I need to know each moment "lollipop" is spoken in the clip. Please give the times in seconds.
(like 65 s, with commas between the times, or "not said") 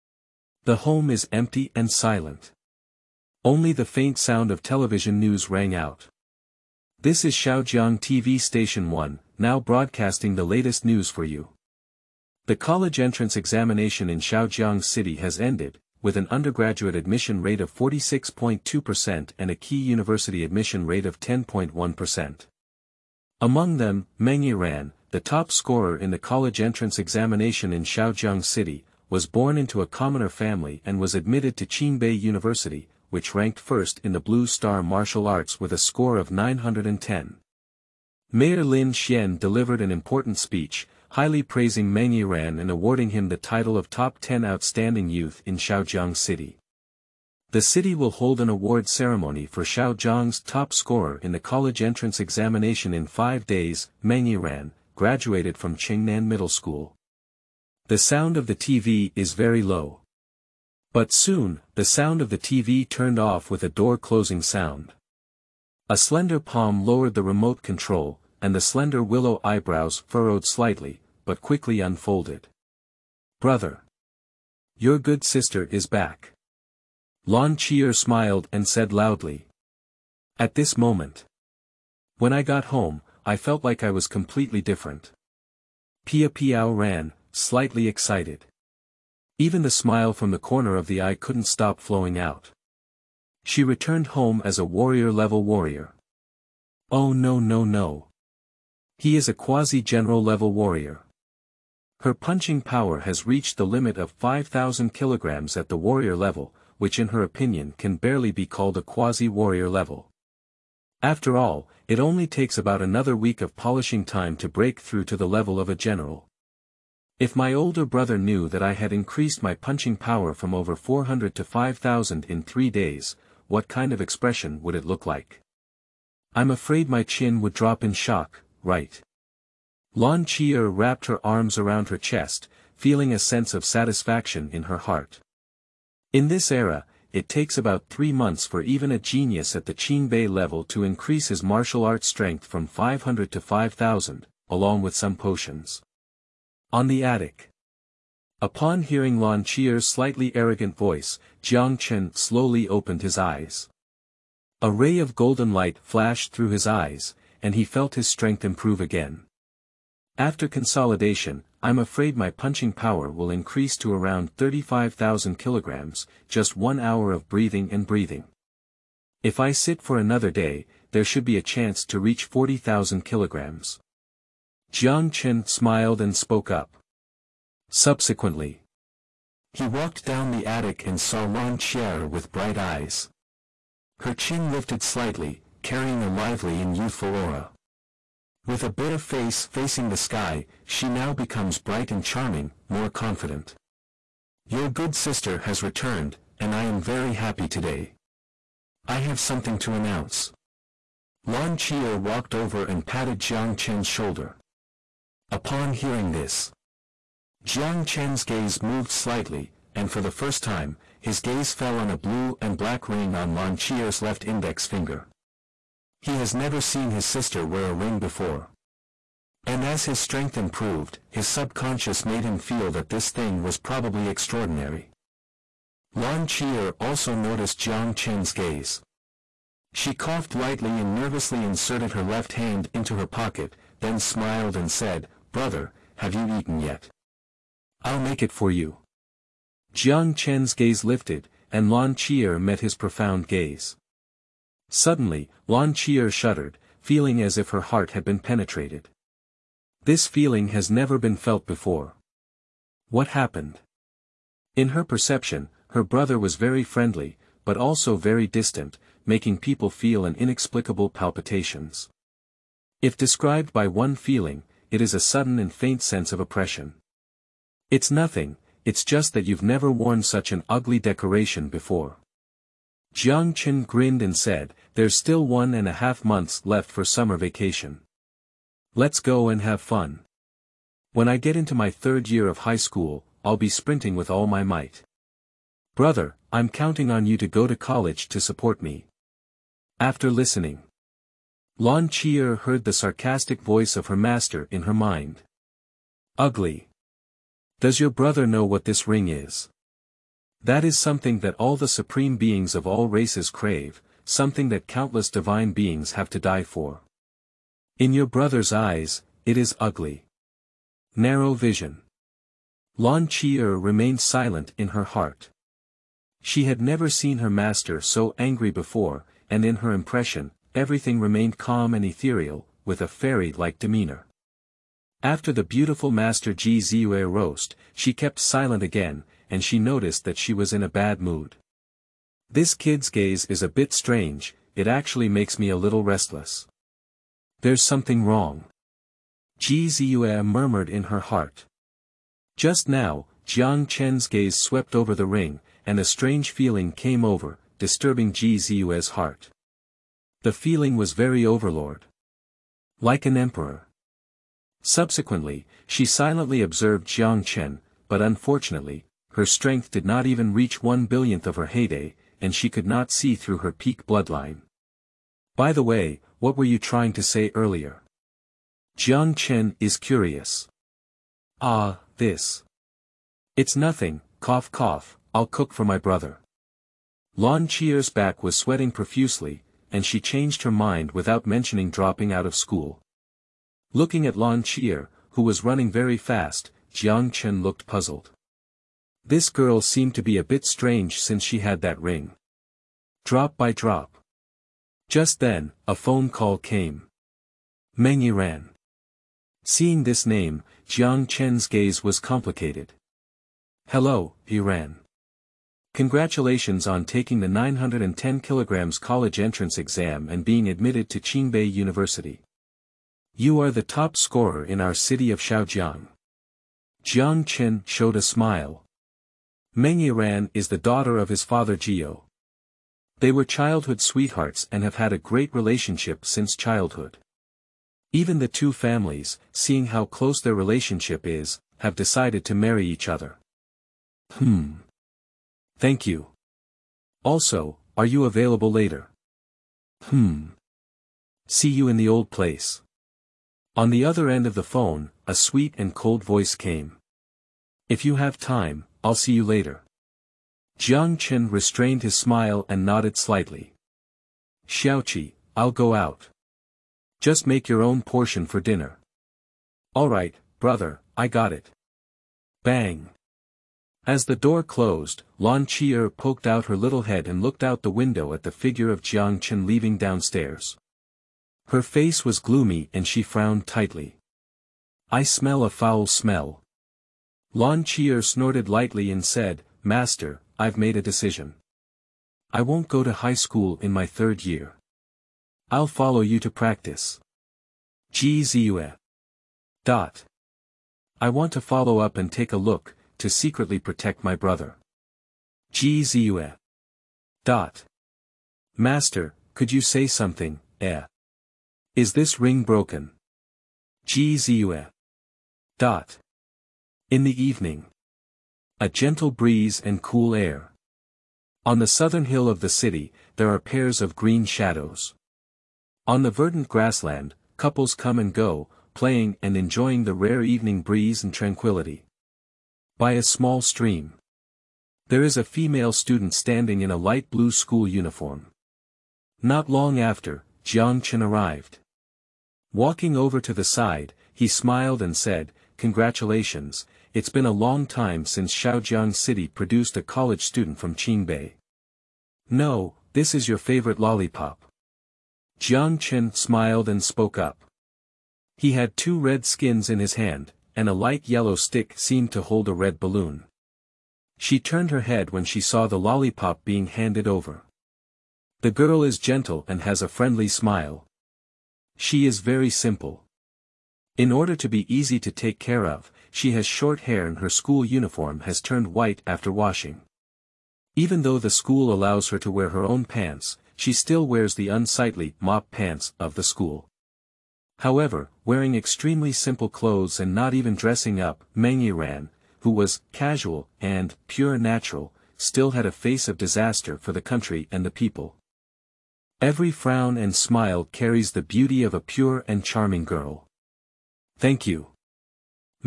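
543 s, 555 s.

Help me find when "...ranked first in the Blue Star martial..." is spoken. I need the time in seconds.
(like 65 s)
33 s.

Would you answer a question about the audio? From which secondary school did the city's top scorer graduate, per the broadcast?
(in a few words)
Qingnan Middle School.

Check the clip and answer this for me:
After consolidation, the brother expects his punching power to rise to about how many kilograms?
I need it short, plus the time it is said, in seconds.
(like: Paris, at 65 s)
35,000, at 164 s.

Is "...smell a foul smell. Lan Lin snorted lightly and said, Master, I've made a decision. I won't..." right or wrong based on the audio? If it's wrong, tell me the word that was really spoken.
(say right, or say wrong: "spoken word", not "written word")
wrong: "Chier", not "Lin".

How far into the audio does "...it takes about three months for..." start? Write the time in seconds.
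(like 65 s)
137 s.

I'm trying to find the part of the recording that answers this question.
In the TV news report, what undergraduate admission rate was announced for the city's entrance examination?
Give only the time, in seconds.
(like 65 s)
17 s.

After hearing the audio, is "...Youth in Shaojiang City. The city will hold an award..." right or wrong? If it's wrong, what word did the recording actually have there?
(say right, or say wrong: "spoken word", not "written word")
right.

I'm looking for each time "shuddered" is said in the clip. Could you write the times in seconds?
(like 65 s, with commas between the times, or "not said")
246 s.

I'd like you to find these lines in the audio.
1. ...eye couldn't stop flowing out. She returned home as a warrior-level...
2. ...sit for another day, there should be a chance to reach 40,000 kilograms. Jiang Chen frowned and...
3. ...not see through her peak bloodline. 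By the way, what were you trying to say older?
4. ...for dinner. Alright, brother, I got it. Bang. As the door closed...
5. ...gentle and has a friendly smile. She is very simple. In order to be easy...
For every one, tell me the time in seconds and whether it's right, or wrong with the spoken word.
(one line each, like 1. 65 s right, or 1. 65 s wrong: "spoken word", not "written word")
1. 90 s right
2. 169 s wrong: "smiled", not "frowned"
3. 362 s wrong: "earlier", not "older"
4. 458 s right
5. 558 s right.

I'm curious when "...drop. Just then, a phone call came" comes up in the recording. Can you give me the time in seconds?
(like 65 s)
393 s.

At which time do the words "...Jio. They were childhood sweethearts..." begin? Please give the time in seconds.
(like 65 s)
421 s.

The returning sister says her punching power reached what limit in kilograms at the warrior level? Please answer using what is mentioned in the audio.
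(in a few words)
5,000 kilograms.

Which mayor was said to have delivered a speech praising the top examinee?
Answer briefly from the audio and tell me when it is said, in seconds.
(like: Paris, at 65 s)
Lin Xian, at 38 s.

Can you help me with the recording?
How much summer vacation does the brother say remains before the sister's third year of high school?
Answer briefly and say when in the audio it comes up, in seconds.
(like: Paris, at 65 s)
one and a half months, at 275 s.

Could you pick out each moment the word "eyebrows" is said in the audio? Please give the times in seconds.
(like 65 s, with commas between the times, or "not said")
69 s.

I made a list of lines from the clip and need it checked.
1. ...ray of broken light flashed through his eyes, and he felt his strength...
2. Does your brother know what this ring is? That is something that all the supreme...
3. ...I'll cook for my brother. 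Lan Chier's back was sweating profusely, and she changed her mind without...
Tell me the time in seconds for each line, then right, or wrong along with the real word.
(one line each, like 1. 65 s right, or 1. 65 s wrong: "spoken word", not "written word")
1. 154 s wrong: "golden", not "broken"
2. 297 s right
3. 375 s right.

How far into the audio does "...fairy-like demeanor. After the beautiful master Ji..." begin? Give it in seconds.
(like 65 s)
322 s.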